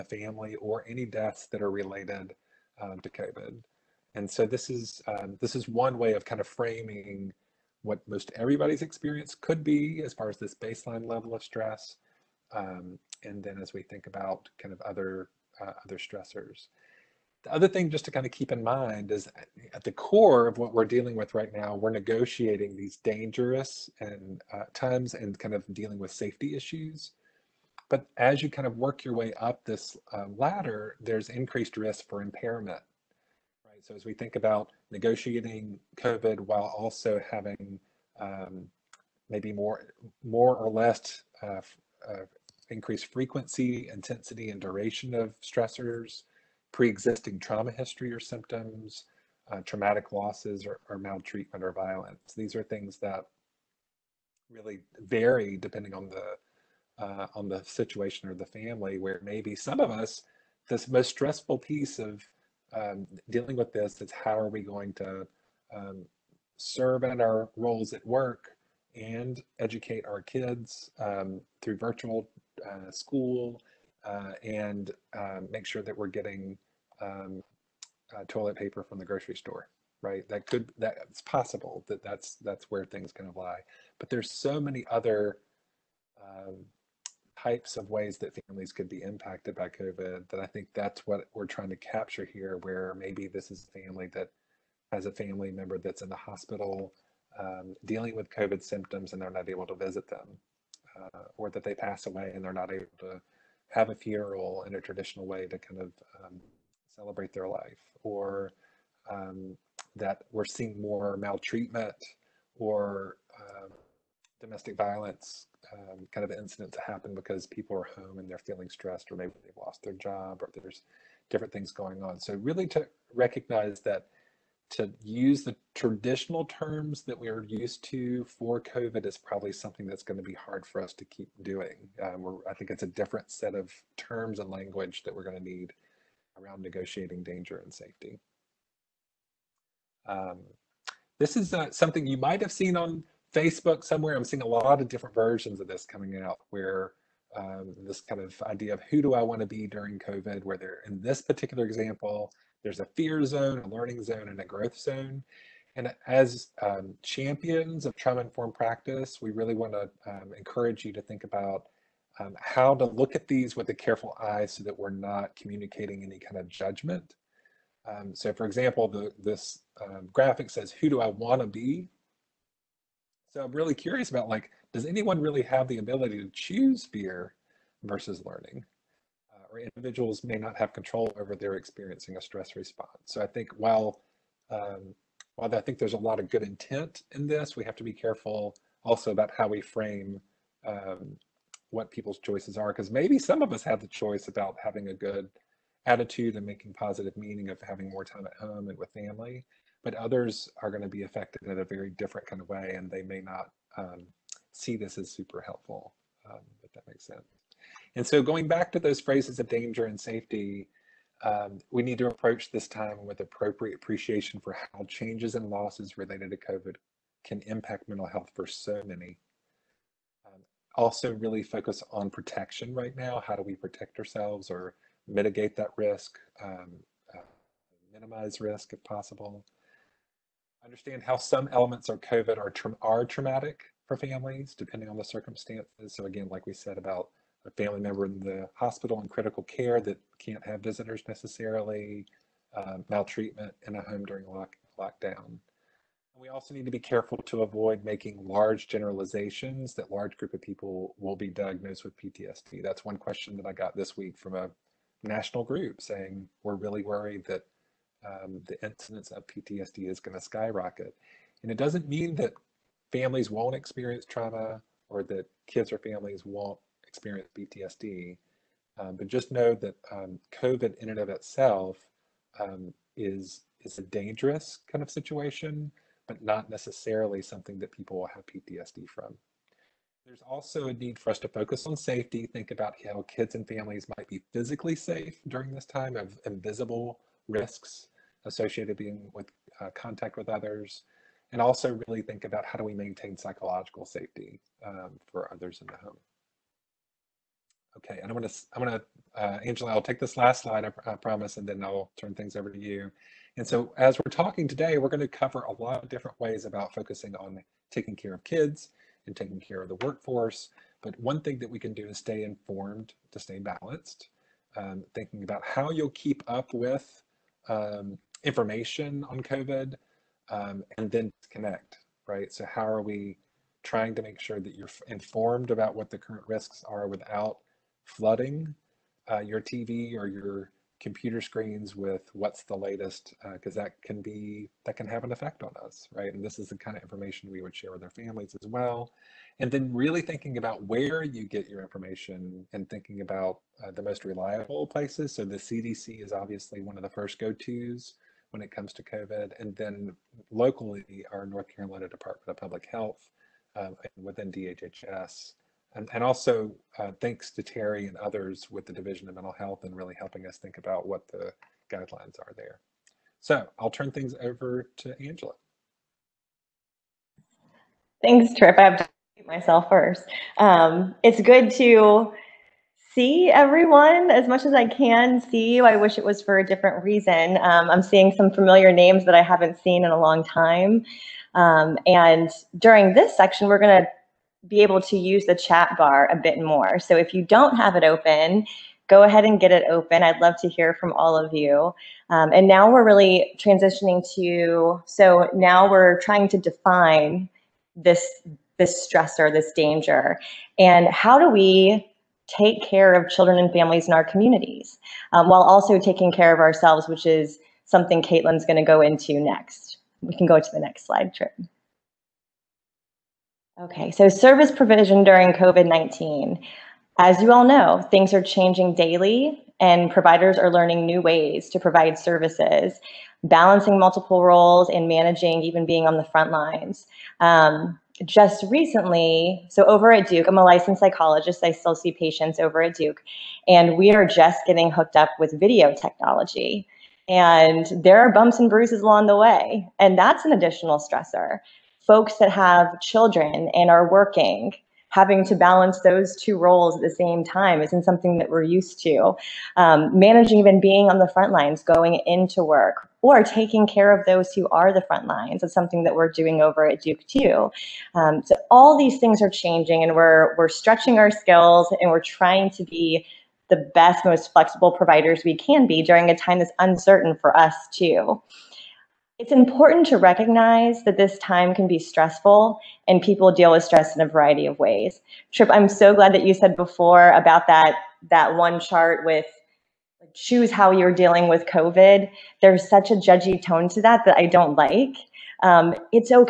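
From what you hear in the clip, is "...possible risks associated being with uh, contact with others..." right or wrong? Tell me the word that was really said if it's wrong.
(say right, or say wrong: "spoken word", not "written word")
wrong: "invisible", not "possible".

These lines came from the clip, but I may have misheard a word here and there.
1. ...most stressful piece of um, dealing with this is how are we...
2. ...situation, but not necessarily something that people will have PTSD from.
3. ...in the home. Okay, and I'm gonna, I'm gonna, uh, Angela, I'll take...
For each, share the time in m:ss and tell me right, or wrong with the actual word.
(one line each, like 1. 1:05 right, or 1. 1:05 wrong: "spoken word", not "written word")
1. 1:00 right
2. 4:34 right
3. 4:55 right.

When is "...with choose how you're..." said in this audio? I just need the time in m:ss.
7:59.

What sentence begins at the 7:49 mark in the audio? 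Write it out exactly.
It's important to recognize that this time can be stressful and people deal with stress in a variety of ways.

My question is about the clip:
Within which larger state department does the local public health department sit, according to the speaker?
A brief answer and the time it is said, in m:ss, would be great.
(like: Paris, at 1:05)
DHHS, at 5:54.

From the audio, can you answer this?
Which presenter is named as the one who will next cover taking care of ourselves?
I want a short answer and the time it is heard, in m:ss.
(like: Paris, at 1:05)
Caitlin, at 6:48.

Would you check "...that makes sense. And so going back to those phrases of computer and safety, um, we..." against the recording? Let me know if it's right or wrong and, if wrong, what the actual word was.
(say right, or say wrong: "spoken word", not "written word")
wrong: "danger", not "computer".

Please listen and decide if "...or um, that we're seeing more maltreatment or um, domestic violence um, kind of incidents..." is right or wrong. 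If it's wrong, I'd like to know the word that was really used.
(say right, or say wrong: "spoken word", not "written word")
right.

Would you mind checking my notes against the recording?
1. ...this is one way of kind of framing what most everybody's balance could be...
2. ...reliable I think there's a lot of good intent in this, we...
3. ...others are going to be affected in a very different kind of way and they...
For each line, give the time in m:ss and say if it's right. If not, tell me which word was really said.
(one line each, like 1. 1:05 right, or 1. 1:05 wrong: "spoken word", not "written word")
1. 0:05 wrong: "experience", not "balance"
2. 3:05 wrong: "while", not "reliable"
3. 3:19 right.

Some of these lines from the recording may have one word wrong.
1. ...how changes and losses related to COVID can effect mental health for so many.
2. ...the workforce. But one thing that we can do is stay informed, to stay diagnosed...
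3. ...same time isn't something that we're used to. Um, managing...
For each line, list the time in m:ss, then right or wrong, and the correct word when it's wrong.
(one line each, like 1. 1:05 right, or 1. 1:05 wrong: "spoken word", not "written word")
1. 3:34 wrong: "impact", not "effect"
2. 5:09 wrong: "balanced", not "diagnosed"
3. 7:26 right.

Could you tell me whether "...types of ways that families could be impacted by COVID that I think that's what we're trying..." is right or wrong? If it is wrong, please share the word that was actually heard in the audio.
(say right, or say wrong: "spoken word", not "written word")
right.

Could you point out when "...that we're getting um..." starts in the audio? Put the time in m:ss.
1:15.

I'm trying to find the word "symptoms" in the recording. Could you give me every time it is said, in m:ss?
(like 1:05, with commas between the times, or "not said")
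0:48, 1:38.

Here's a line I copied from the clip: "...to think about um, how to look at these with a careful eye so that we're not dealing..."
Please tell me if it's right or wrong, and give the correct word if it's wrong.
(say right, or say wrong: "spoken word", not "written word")
wrong: "communicating", not "dealing".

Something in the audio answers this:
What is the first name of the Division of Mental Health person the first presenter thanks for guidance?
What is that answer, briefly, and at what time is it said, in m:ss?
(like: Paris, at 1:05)
Terry, at 5:57.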